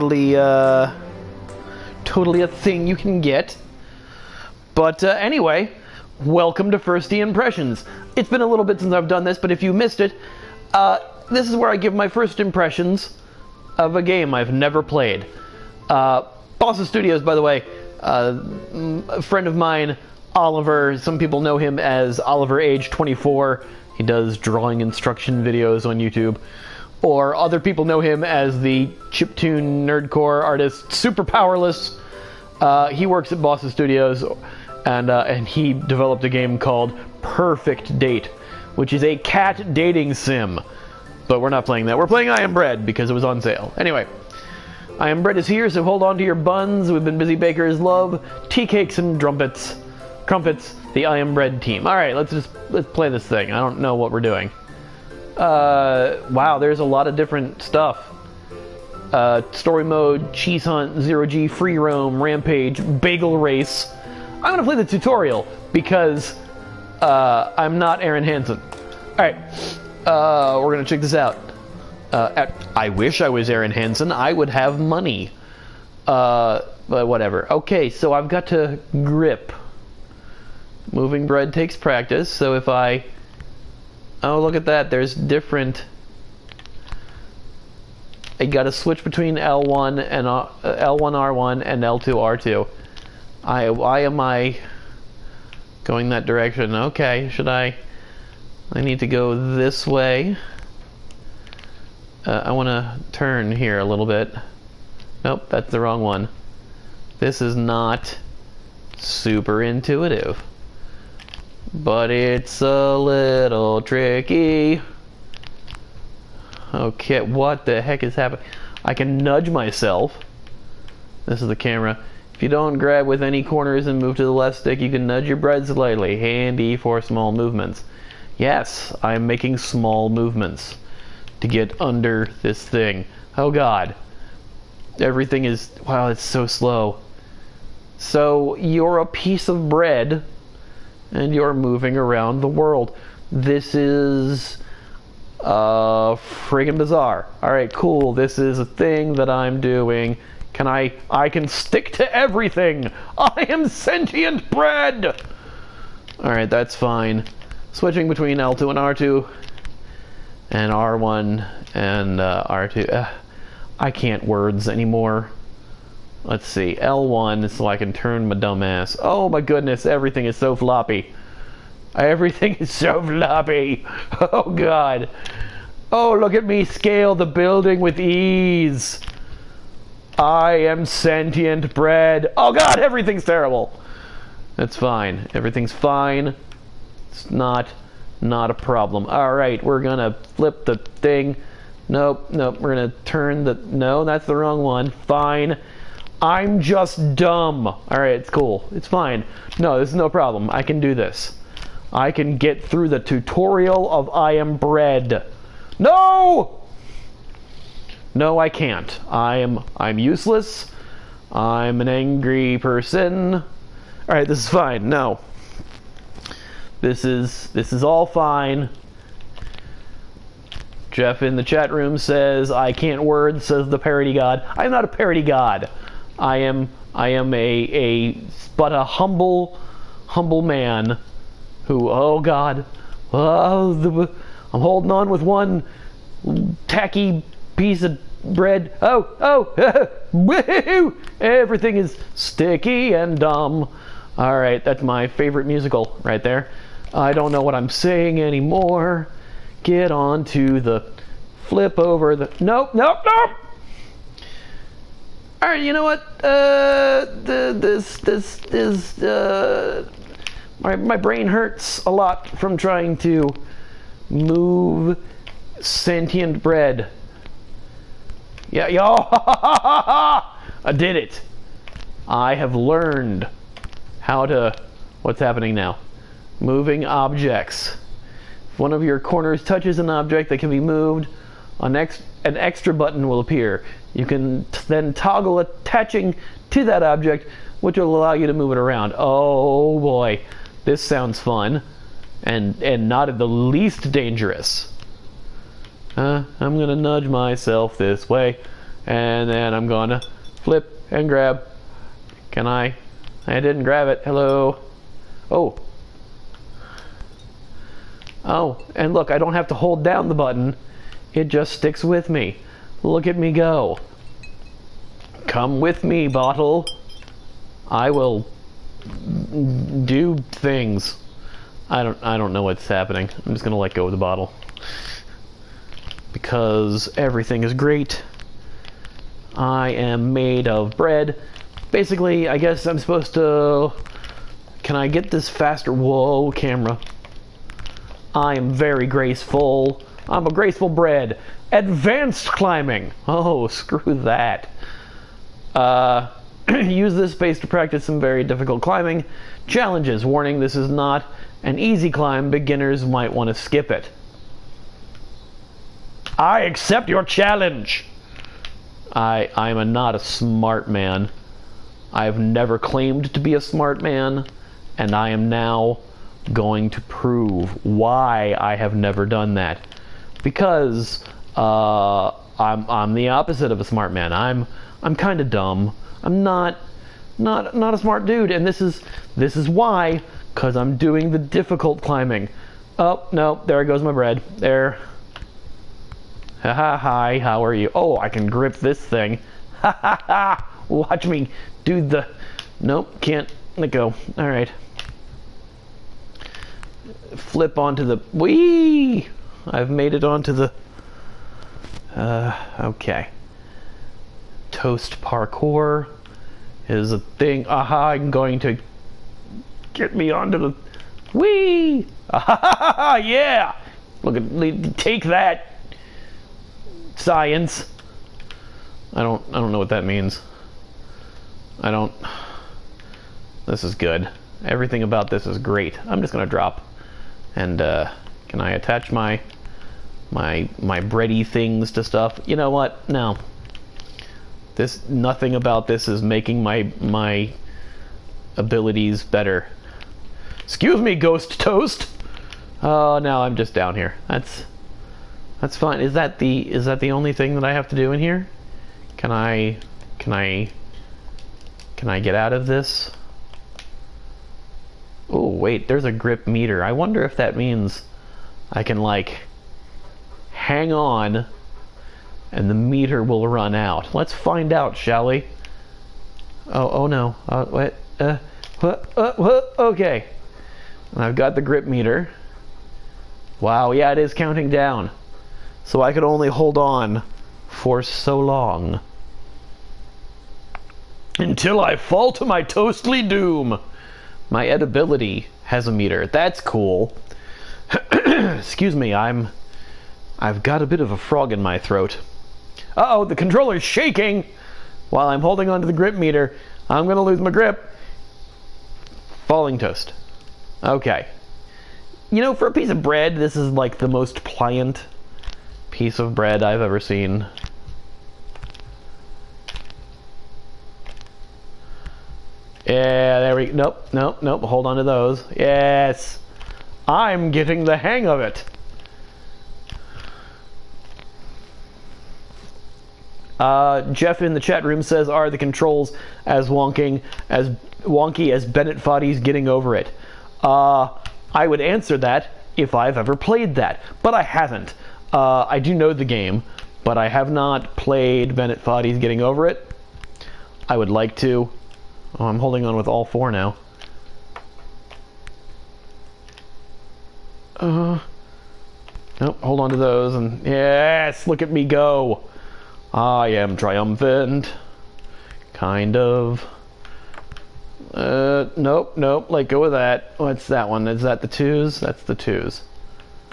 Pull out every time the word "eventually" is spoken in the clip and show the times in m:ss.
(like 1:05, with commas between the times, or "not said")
not said.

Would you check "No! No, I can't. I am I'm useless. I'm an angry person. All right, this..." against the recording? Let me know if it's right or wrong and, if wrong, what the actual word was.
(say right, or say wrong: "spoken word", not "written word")
right.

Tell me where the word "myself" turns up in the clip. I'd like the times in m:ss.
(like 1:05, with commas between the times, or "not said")
1:59, 4:57.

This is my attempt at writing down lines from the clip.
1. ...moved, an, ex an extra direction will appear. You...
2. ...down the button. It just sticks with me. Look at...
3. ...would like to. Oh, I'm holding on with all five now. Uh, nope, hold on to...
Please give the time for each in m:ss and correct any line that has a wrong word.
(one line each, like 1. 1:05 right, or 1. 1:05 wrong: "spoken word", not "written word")
1. 4:40 wrong: "button", not "direction"
2. 5:09 right
3. 9:00 wrong: "four", not "five".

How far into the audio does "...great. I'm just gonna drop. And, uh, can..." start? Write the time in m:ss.
7:05.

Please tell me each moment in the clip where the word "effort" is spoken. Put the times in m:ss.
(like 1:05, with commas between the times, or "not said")
not said.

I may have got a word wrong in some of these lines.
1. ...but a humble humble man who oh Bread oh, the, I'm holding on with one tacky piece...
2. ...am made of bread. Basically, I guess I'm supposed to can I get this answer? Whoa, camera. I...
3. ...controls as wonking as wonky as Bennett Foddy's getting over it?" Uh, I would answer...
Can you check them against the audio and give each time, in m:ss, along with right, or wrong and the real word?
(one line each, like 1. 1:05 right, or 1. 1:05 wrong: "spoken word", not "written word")
1. 3:48 wrong: "God", not "Bread"
2. 5:29 wrong: "faster", not "answer"
3. 8:45 right.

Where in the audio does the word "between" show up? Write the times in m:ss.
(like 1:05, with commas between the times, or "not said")
1:29, 2:38.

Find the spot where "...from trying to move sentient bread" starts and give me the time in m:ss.
4:22.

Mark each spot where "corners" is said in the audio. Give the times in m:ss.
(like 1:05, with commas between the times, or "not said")
2:03, 4:38.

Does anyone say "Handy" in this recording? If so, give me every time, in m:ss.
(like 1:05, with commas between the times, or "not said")
2:06.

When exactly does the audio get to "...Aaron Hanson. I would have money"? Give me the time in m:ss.
1:13.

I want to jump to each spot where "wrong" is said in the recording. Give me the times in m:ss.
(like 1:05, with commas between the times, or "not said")
1:45, 3:14.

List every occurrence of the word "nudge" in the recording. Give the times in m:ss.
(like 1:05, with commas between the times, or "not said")
1:59, 2:05, 4:56.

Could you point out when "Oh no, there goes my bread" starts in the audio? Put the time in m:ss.
6:22.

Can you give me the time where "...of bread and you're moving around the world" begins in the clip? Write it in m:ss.
2:19.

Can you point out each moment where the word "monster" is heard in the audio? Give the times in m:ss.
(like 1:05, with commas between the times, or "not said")
not said.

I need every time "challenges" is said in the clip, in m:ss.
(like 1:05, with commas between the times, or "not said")
5:49, 5:57.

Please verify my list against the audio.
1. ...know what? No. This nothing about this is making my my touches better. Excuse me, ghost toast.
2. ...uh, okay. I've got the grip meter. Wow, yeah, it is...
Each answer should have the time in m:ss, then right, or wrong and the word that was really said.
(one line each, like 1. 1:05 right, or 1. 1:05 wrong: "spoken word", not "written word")
1. 7:12 wrong: "abilities", not "touches"
2. 7:48 right.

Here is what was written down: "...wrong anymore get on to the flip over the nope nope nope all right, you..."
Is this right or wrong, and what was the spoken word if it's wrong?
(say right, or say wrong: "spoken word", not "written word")
wrong: "saying", not "wrong".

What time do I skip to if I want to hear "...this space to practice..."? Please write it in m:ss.
5:46.